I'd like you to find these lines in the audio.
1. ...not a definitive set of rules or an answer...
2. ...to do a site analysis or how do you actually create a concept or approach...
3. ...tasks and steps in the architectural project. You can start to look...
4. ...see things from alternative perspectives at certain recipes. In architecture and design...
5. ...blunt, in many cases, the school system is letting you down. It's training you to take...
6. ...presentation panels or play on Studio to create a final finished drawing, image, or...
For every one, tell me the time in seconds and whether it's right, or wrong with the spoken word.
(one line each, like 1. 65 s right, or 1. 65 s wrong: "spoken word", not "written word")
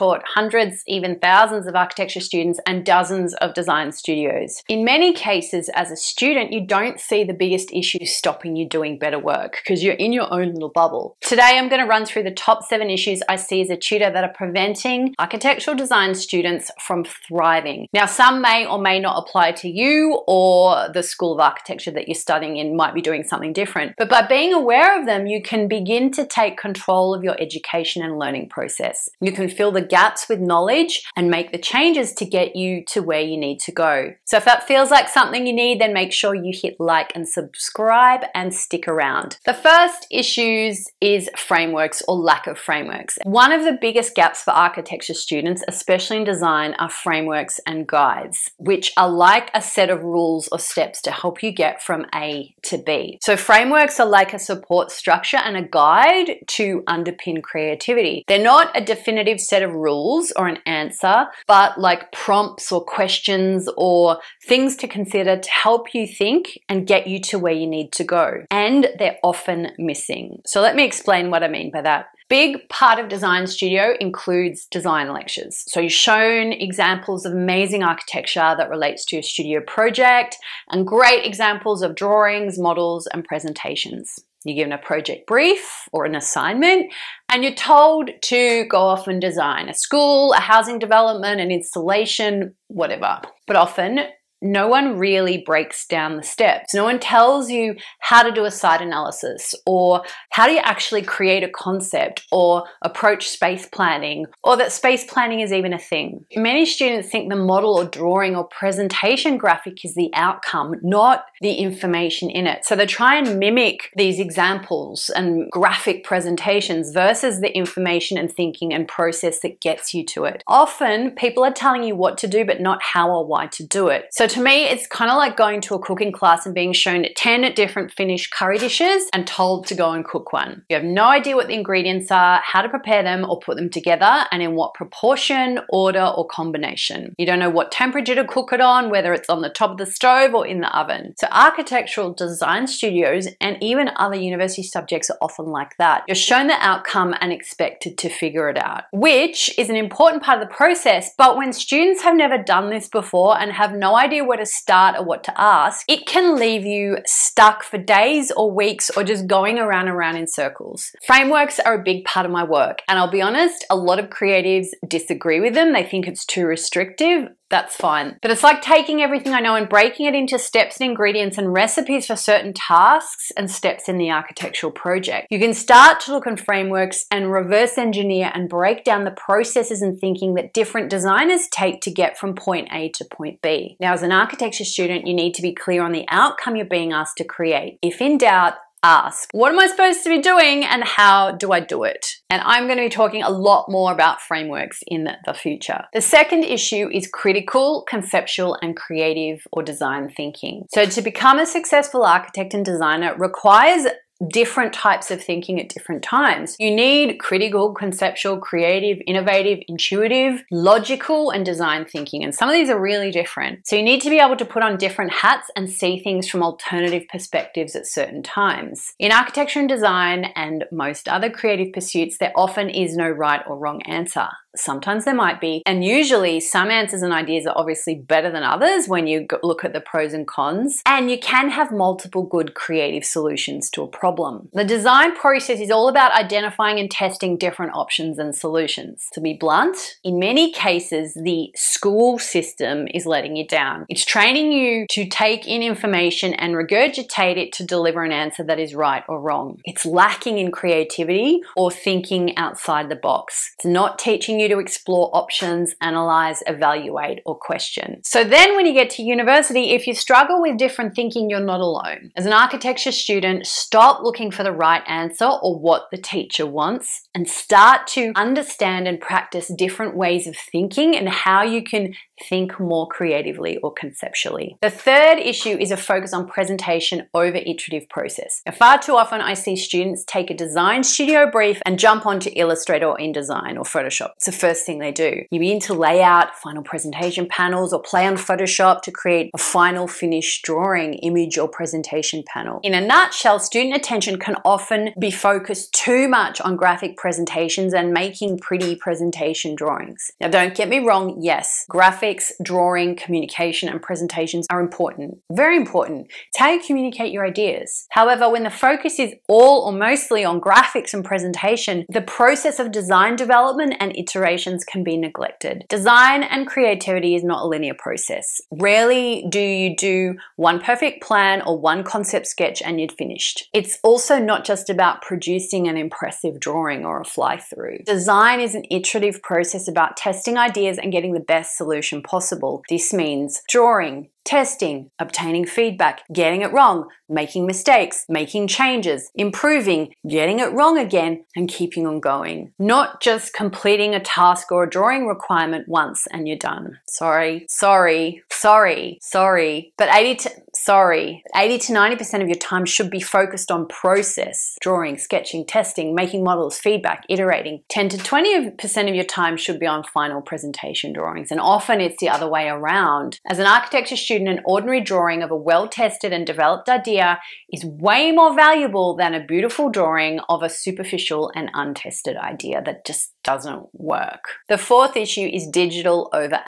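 1. 58 s right
2. 98 s right
3. 172 s right
4. 215 s wrong: "times", not "recipes"
5. 239 s right
6. 286 s wrong: "Photoshop", not "Studio".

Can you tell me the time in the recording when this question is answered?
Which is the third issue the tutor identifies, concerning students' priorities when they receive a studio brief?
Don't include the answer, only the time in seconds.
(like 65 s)
276 s.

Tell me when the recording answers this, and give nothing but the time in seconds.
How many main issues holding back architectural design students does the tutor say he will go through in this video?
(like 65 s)
12 s.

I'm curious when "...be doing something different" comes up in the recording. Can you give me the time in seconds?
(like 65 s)
22 s.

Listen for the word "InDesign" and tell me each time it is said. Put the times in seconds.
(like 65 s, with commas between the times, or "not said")
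282 s.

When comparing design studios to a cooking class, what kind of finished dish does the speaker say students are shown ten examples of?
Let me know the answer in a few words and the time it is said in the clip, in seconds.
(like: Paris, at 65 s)
curry, at 128 s.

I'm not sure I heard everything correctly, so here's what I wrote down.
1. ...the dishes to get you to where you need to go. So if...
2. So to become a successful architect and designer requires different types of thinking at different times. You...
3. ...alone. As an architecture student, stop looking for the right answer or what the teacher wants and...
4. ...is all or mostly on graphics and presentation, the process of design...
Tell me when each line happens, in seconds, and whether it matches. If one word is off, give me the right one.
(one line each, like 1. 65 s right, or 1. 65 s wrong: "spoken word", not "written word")
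1. 31 s wrong: "changes", not "dishes"
2. 200 s right
3. 261 s right
4. 308 s right.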